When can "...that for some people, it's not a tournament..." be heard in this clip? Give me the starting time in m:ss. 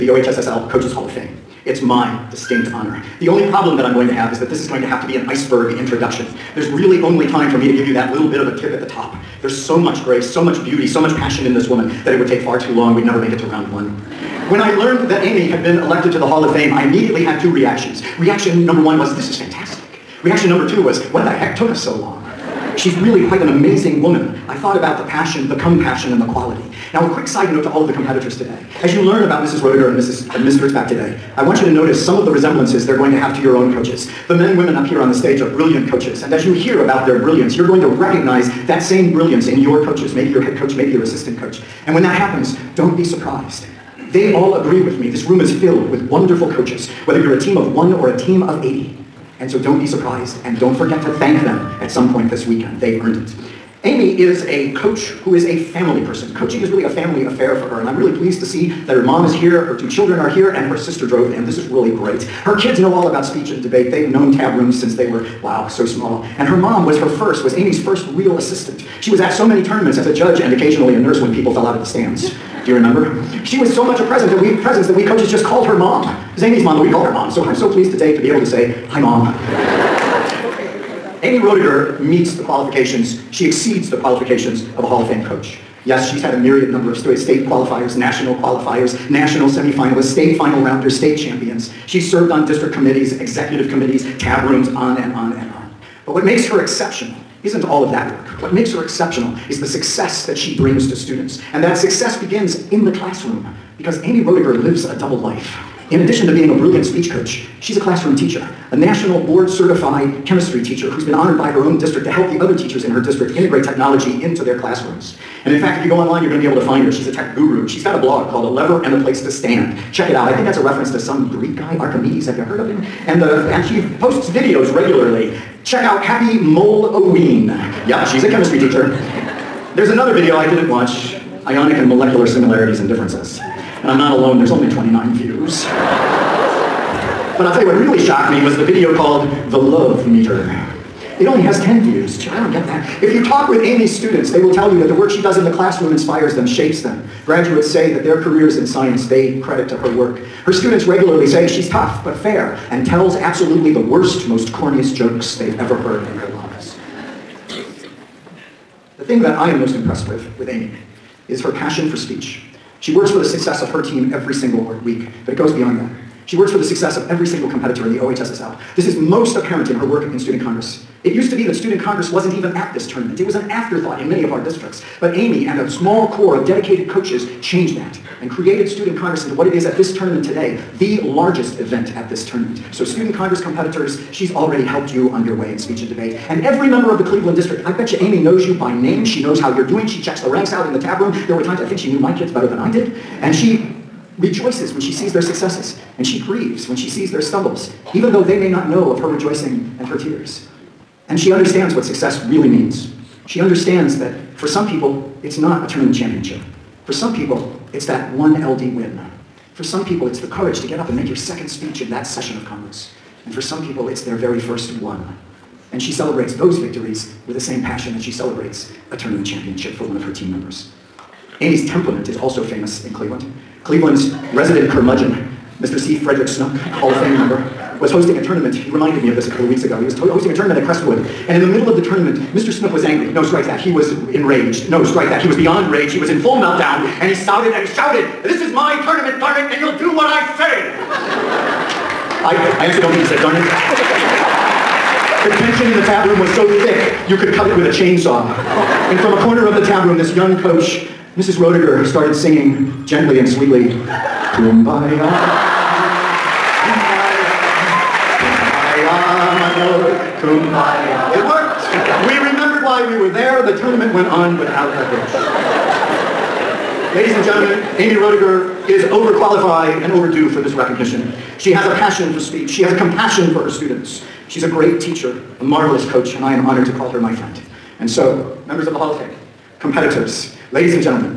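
3:23.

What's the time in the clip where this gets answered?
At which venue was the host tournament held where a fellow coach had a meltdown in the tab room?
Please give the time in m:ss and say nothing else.
3:50.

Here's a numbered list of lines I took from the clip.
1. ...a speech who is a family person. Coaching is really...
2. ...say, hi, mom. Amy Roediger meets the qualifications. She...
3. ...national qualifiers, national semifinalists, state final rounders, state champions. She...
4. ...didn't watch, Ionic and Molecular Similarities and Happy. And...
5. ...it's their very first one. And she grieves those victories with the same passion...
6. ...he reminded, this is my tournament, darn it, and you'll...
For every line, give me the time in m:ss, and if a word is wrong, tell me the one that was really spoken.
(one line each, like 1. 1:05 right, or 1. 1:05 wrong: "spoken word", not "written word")
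1. 0:54 wrong: "coach", not "speech"
2. 1:18 right
3. 1:27 right
4. 2:10 wrong: "Differences", not "Happy"
5. 3:33 wrong: "celebrates", not "grieves"
6. 3:57 wrong: "shouted", not "reminded".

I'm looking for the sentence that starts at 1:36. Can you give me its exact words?
But what makes her exceptional isn't all of that work.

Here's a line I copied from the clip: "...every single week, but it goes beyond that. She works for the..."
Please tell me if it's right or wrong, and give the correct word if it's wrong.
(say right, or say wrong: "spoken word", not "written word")
right.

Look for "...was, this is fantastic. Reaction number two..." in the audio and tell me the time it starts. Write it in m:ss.
0:18.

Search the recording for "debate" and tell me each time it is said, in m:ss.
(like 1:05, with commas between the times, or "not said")
1:03, 3:05.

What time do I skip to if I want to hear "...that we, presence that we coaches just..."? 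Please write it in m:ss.
1:14.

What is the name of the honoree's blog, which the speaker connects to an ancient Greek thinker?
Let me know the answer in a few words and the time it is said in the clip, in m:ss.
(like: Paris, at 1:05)
A Lever and a Place to Stand, at 1:58.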